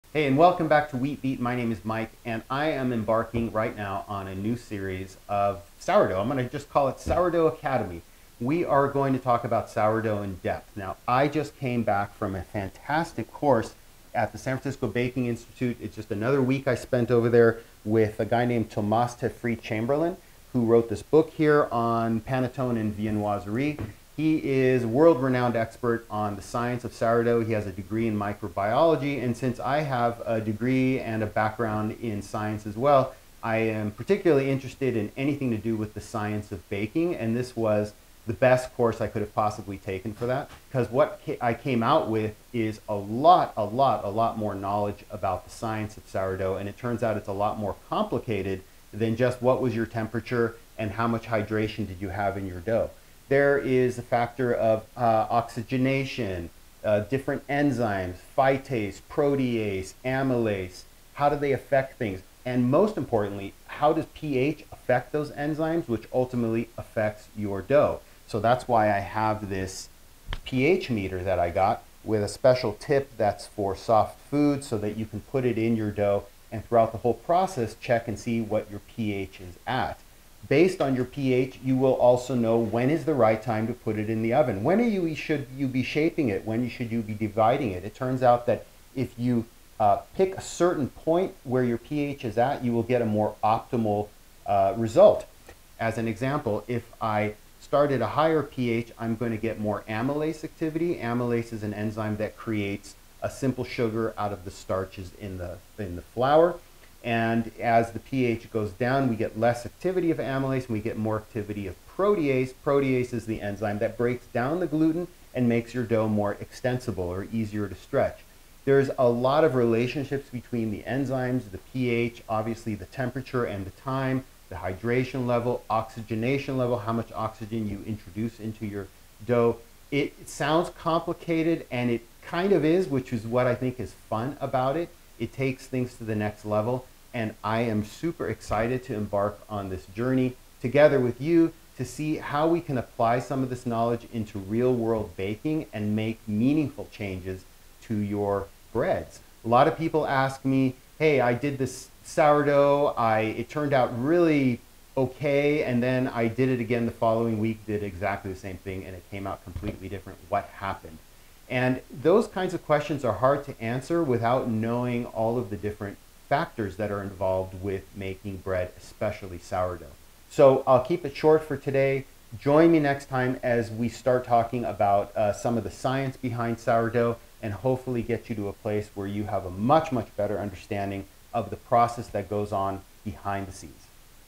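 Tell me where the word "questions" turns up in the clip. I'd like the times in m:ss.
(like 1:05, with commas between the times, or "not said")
2:42.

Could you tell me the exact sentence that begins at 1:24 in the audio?
When you, should you be shaping it?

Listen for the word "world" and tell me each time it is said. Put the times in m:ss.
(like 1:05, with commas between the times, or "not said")
0:24, 2:24.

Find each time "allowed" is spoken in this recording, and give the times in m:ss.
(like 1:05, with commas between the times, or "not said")
not said.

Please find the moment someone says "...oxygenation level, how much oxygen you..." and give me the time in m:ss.
2:05.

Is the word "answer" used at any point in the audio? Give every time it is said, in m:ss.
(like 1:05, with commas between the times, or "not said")
2:43.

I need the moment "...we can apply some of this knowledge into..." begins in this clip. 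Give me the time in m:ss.
2:22.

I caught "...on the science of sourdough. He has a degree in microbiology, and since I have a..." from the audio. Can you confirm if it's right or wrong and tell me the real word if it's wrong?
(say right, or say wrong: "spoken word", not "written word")
right.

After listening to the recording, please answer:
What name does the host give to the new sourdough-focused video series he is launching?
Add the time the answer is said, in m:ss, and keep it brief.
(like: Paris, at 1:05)
Sourdough Academy, at 0:06.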